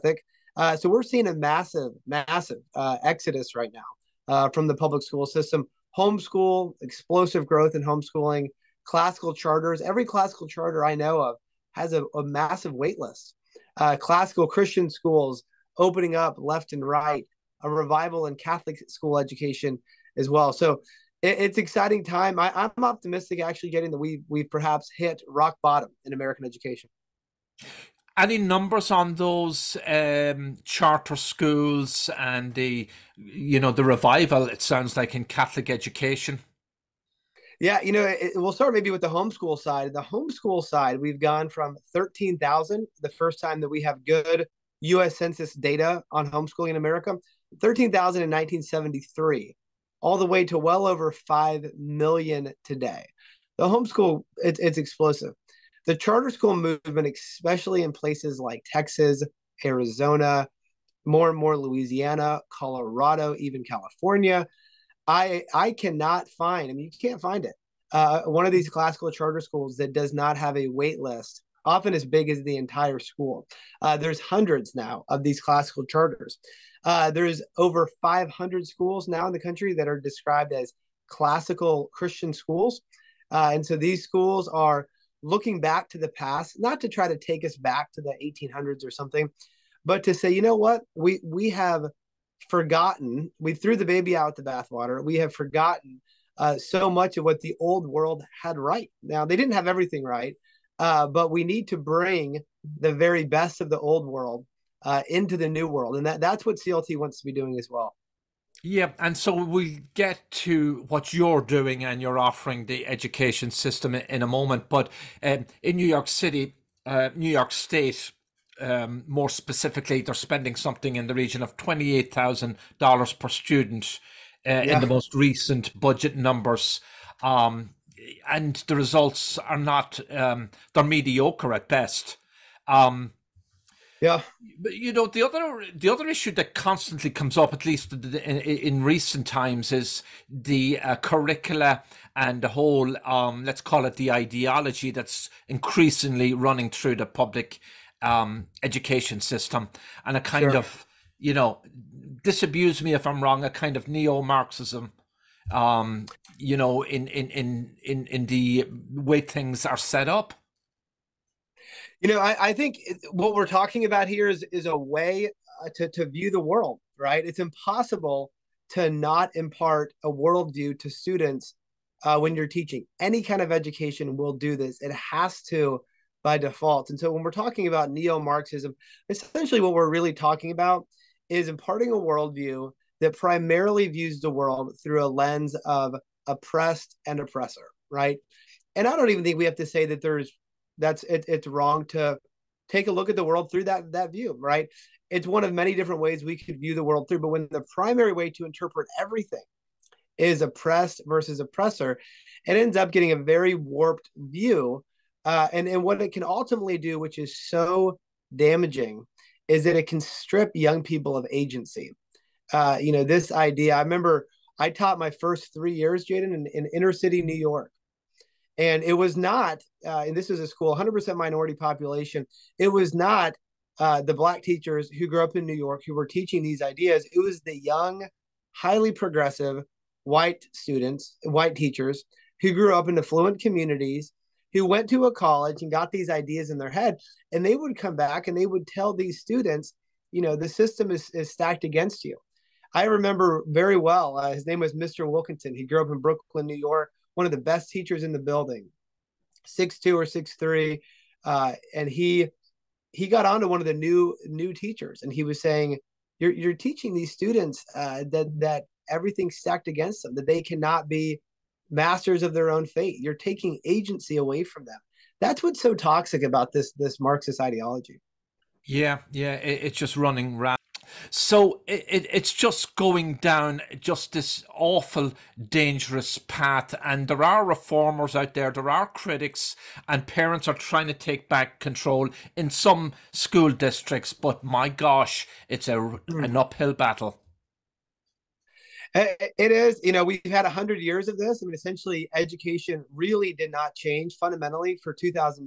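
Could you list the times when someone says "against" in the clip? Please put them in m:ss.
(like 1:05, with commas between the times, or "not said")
4:01, 4:19.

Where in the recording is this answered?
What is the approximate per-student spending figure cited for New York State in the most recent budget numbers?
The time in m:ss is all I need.
2:01.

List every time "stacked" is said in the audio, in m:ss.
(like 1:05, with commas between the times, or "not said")
4:01, 4:19.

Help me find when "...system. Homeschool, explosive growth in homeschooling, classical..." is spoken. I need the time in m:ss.
0:05.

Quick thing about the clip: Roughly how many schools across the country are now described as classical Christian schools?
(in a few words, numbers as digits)
over 500.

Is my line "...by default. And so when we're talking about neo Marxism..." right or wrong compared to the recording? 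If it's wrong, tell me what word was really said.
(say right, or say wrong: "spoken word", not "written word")
right.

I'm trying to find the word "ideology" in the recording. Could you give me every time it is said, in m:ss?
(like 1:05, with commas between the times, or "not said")
2:24, 4:27.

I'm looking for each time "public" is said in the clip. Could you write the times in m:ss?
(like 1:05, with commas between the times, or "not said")
0:04, 2:27.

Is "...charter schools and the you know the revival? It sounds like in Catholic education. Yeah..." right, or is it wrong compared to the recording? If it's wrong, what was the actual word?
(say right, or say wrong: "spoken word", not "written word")
right.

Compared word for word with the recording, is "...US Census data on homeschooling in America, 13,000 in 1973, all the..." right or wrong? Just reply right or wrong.
right.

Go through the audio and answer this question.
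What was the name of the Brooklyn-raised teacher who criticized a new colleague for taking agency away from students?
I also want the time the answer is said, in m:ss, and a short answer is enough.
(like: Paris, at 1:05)
Mr. Wilkinson, at 4:04.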